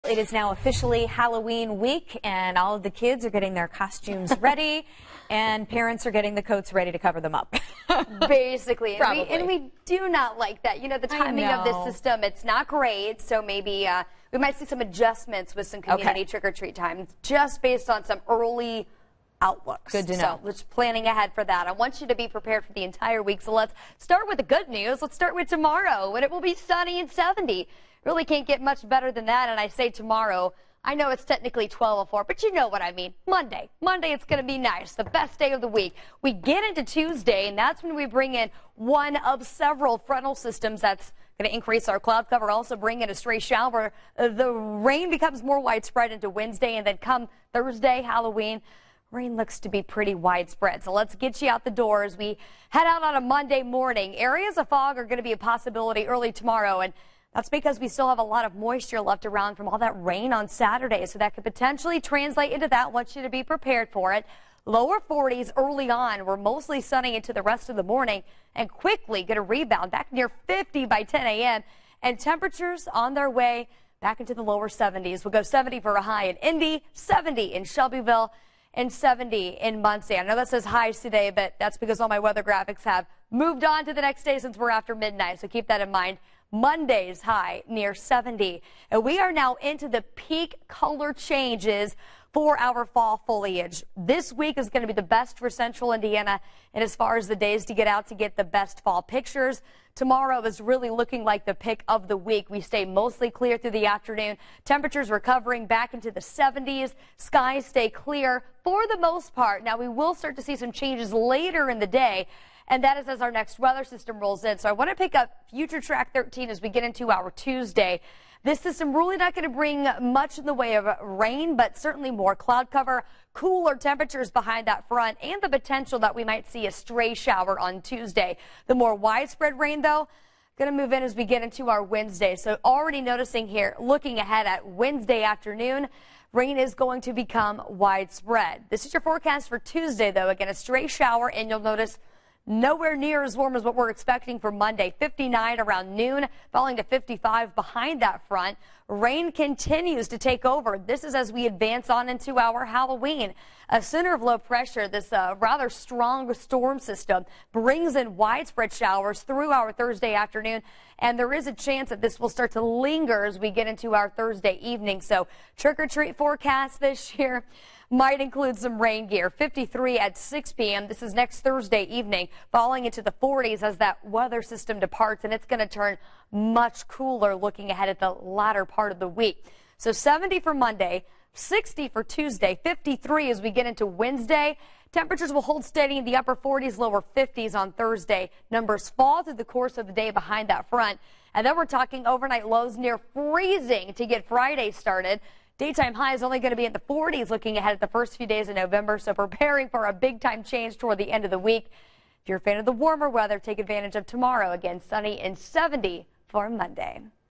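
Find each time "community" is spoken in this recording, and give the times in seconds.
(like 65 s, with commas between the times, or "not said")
15 s.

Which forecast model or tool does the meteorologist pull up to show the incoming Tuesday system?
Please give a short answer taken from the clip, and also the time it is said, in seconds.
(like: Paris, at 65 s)
Future Track 13, at 115 s.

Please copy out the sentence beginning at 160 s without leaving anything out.
And there is a chance that this will start to linger as we get into our Thursday evening.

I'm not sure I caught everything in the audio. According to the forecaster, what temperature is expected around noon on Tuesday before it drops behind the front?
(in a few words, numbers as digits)
59.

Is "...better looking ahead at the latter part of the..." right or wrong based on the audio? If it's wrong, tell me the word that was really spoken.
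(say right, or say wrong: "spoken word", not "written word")
wrong: "cooler", not "better".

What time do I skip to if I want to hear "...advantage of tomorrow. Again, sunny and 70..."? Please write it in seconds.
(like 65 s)
203 s.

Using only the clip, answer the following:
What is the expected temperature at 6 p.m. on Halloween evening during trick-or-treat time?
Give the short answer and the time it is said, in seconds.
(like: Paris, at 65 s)
53, at 169 s.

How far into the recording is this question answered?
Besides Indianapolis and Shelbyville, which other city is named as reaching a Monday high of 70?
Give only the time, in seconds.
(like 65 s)
78 s.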